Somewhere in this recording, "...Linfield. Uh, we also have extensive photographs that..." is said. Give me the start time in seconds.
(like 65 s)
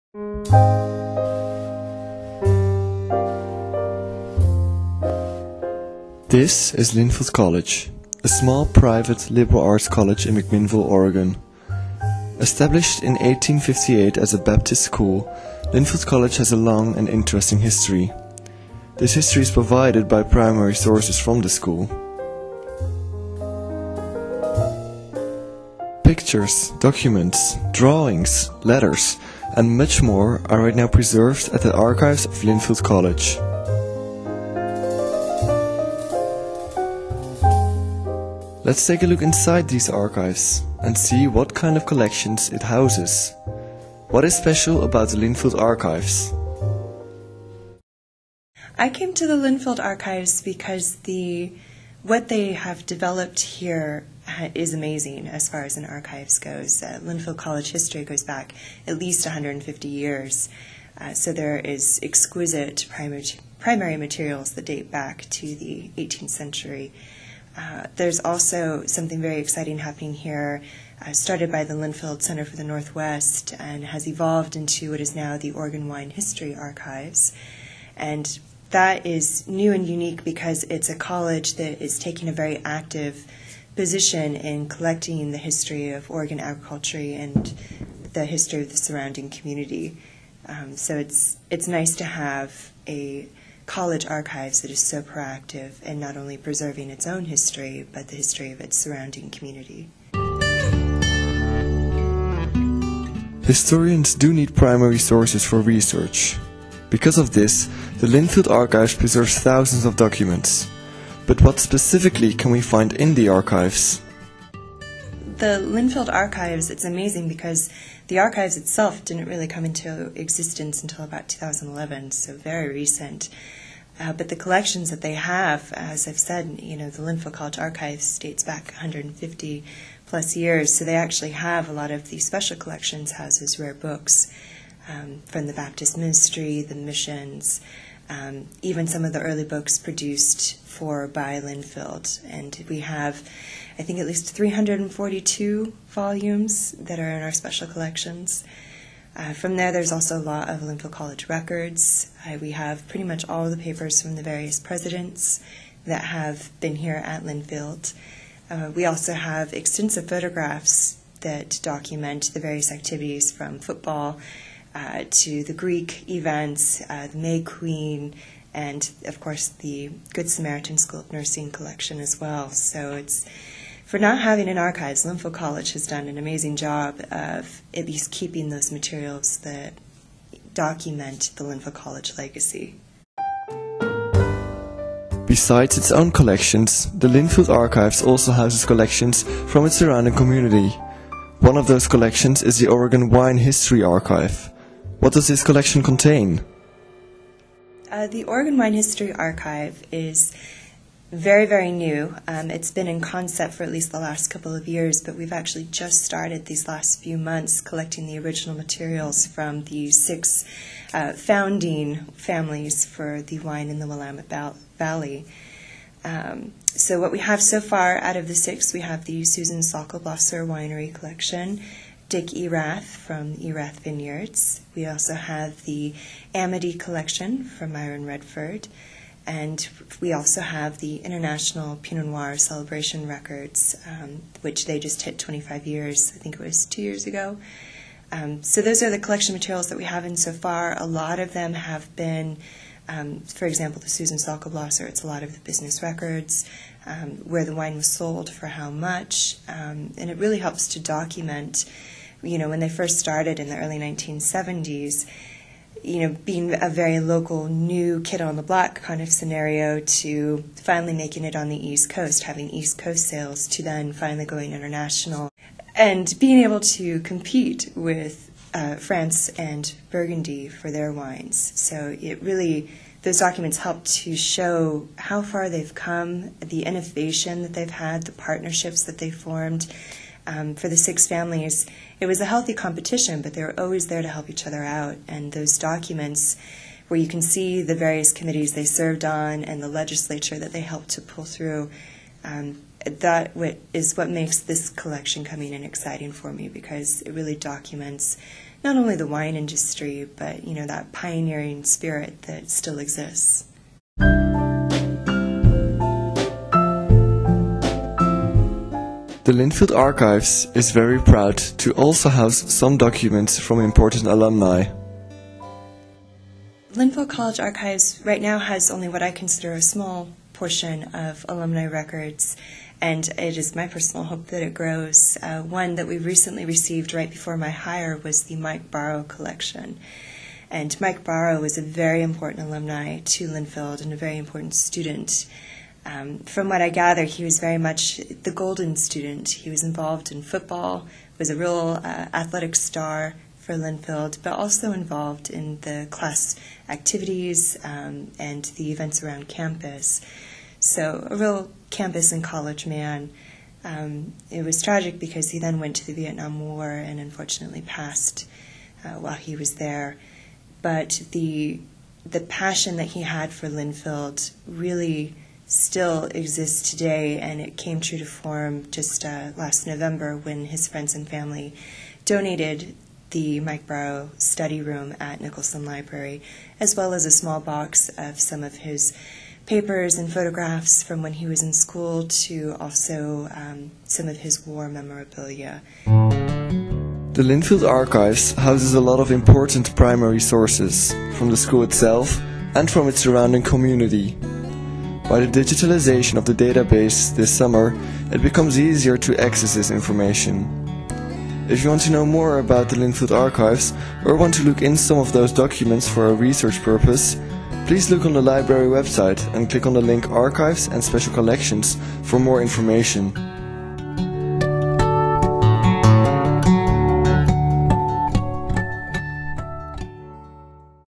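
157 s.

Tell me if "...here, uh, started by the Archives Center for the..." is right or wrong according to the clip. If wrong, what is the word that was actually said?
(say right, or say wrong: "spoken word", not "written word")
wrong: "Linfield", not "Archives".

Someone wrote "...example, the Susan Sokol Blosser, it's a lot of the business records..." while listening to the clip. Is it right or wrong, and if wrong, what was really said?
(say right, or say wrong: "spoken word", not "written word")
right.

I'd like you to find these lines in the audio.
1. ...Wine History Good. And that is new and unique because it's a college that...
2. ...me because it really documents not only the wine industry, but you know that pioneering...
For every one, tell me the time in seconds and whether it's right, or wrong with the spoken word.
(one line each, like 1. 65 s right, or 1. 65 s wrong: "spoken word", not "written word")
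1. 75 s wrong: "Archives", not "Good"
2. 296 s right.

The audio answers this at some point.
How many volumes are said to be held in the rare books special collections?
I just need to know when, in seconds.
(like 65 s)
144 s.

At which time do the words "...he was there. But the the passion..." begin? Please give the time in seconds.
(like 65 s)
359 s.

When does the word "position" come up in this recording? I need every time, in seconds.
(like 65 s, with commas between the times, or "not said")
83 s.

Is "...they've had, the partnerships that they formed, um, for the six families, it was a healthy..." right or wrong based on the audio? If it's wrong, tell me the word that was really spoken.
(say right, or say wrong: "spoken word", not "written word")
right.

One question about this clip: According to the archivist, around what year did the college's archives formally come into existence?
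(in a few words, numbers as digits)
2011.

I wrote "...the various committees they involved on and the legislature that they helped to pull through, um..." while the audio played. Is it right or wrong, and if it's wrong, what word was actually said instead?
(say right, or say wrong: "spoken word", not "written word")
wrong: "served", not "involved".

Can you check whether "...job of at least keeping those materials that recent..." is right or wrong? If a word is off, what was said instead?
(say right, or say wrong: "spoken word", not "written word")
wrong: "document", not "recent".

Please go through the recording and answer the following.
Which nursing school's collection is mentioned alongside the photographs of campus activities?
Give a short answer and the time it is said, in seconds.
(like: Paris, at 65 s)
Good Samaritan School of Nursing, at 170 s.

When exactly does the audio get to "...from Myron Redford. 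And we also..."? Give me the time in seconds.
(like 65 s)
227 s.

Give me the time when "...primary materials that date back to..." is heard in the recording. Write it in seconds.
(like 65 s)
63 s.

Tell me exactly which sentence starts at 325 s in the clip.
Uh, one that we recently received right before my hire was the Mike Barrow collection.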